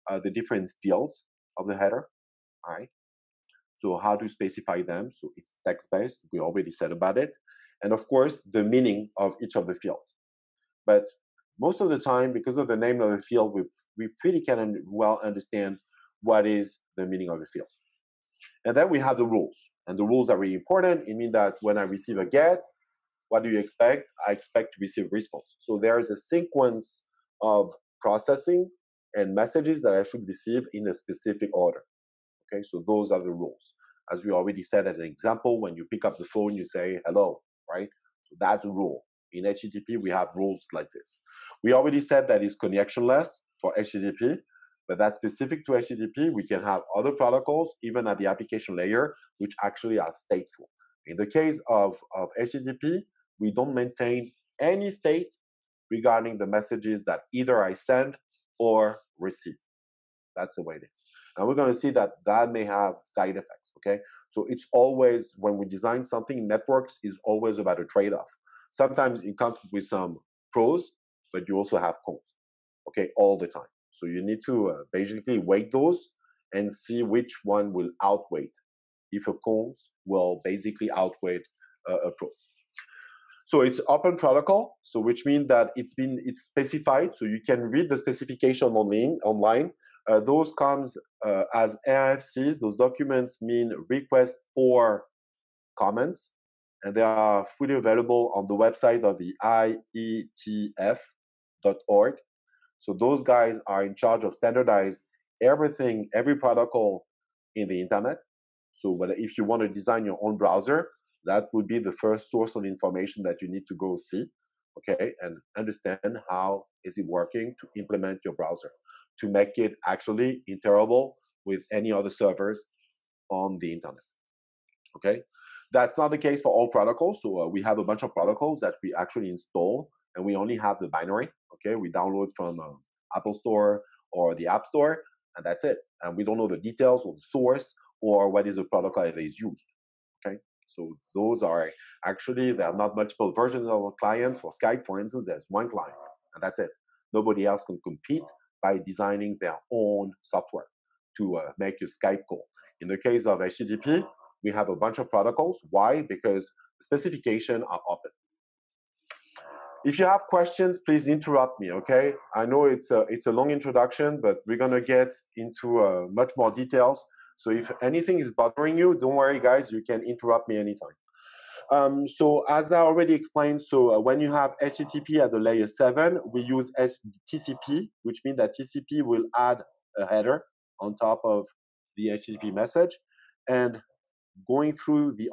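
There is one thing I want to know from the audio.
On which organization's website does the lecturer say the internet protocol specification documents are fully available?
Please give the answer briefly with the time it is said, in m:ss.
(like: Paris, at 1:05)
IETF.org, at 1:40.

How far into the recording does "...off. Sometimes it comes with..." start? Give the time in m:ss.
1:08.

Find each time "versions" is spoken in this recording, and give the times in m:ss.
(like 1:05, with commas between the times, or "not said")
2:23.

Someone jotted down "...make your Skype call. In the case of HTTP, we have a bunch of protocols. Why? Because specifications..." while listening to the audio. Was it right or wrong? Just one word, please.
right.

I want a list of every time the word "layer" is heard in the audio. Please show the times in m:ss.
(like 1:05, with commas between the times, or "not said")
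0:48, 2:55.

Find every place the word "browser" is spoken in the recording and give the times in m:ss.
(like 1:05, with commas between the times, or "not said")
1:50, 1:58.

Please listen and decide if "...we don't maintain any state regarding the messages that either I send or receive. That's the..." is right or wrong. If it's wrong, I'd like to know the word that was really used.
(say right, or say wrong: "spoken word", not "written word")
right.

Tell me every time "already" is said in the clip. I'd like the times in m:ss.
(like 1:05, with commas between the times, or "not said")
0:06, 0:34, 0:41, 2:52.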